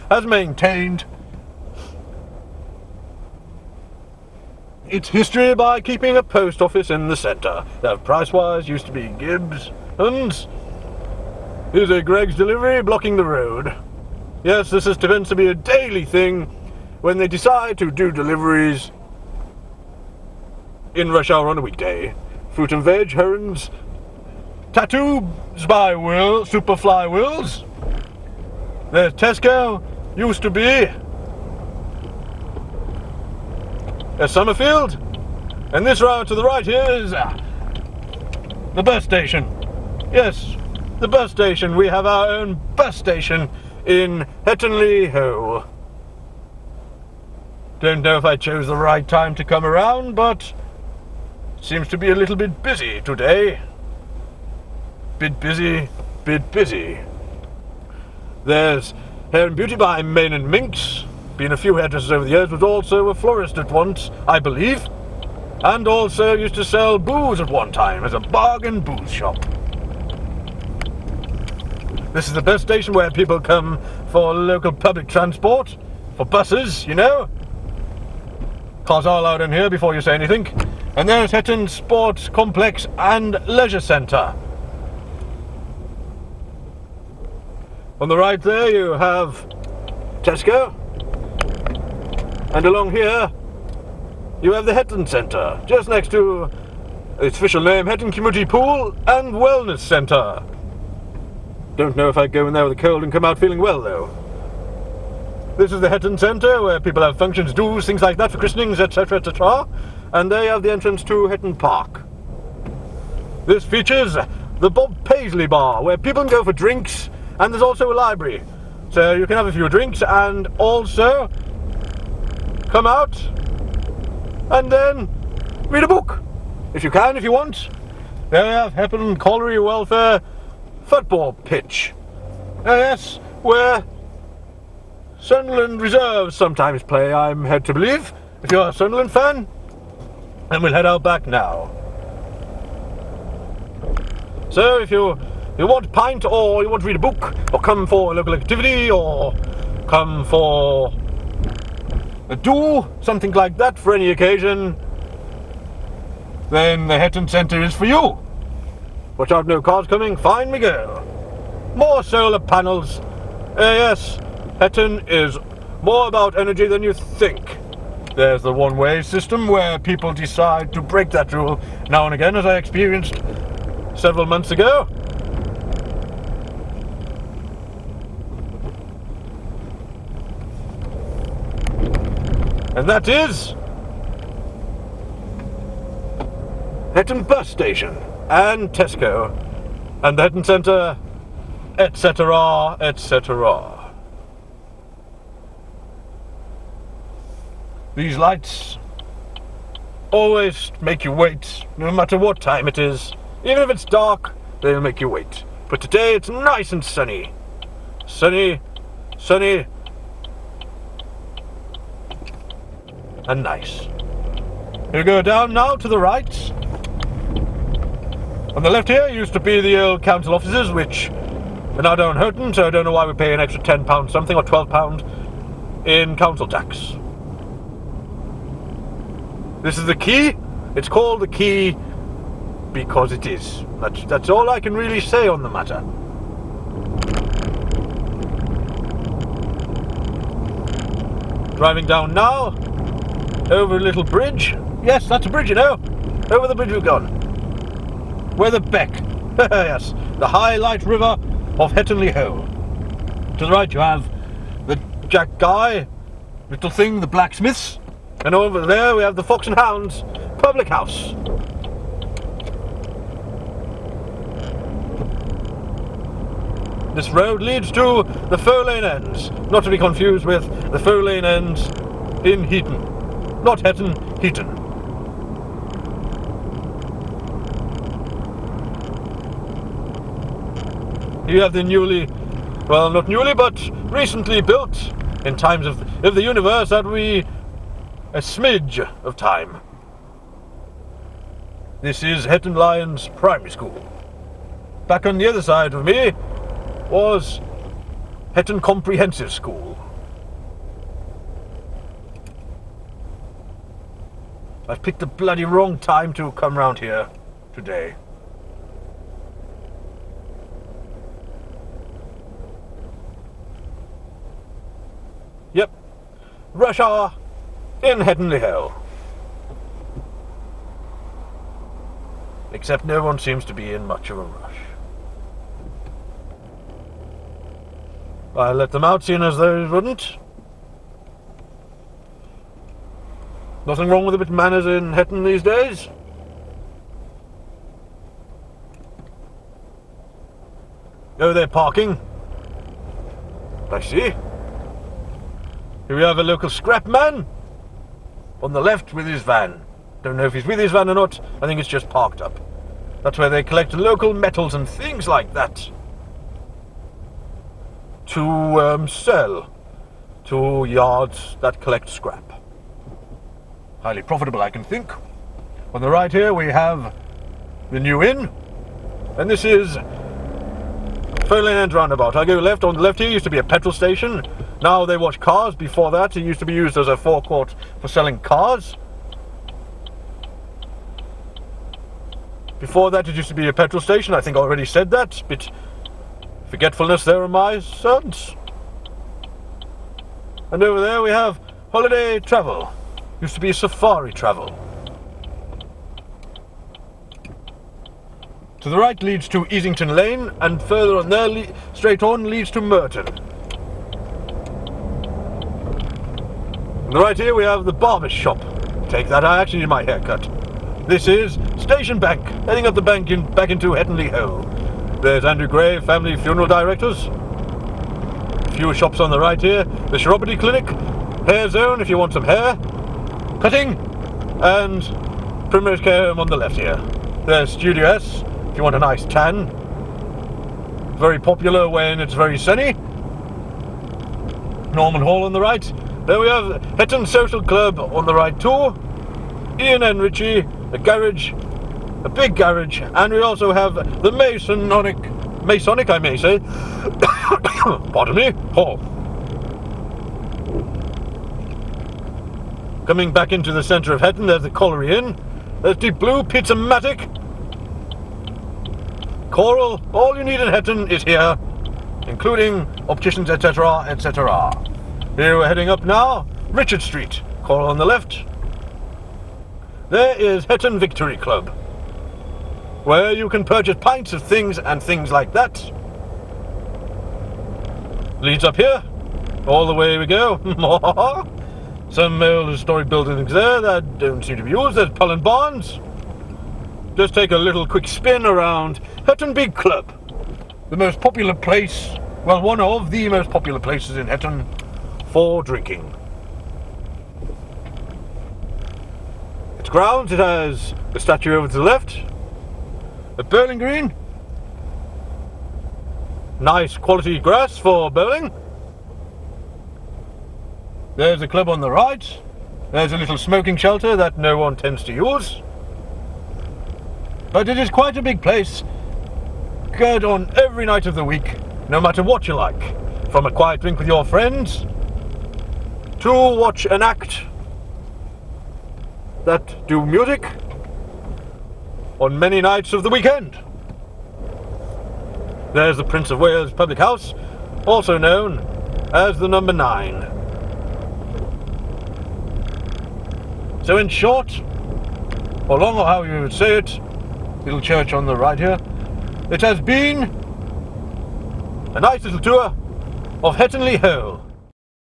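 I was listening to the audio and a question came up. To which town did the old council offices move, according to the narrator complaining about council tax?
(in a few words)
Houghton.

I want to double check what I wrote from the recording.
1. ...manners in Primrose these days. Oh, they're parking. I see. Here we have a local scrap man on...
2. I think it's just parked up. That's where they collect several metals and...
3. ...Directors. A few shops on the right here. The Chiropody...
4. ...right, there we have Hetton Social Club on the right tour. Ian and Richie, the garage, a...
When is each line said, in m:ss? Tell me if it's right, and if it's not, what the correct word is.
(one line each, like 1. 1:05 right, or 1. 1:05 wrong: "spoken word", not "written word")
1. 5:34 wrong: "Hetton", not "Primrose"
2. 5:51 wrong: "local", not "several"
3. 6:56 right
4. 7:15 right.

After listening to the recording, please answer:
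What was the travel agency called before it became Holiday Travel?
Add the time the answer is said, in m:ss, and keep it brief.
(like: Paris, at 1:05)
Safari Travel, at 6:33.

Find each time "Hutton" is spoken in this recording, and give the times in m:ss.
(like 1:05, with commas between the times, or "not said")
8:09, 8:14.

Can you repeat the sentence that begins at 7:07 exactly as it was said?
There's Studio S if you want a nice tan.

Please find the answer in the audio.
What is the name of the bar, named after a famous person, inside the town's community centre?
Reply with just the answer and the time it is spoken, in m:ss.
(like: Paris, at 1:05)
Bob Paisley Bar, at 1:54.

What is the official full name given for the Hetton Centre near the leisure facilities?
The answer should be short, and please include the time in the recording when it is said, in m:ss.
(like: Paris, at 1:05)
Hetton Community Pool and Wellness Centre, at 1:37.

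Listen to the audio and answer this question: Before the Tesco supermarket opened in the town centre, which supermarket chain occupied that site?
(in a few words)
Somerfield.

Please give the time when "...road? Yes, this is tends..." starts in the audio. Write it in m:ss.
0:13.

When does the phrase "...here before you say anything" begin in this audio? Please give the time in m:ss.
1:19.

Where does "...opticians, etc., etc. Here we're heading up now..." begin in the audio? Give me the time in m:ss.
7:42.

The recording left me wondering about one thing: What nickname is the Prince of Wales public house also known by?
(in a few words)
the number nine.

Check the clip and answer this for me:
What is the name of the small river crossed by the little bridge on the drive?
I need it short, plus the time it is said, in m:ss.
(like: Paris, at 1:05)
Weatherbeck, at 4:08.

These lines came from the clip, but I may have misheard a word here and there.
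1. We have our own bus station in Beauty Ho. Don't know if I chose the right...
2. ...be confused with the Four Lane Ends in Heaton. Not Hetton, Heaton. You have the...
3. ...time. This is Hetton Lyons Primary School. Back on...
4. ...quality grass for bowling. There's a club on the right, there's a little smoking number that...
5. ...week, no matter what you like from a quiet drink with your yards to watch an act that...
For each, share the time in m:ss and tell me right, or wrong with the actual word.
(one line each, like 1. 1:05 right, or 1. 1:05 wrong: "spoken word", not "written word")
1. 0:41 wrong: "Hettonley", not "Beauty"
2. 4:29 right
3. 4:49 right
4. 8:26 wrong: "shelter", not "number"
5. 8:41 wrong: "friends", not "yards".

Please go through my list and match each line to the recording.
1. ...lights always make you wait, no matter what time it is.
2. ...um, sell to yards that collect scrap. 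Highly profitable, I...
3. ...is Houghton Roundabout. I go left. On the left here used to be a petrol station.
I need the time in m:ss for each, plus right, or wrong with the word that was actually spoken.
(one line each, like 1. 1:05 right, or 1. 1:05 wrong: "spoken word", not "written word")
1. 3:18 right
2. 5:58 right
3. 6:09 wrong: "Fernland", not "Houghton".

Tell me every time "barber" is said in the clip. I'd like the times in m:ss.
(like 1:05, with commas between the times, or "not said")
6:47.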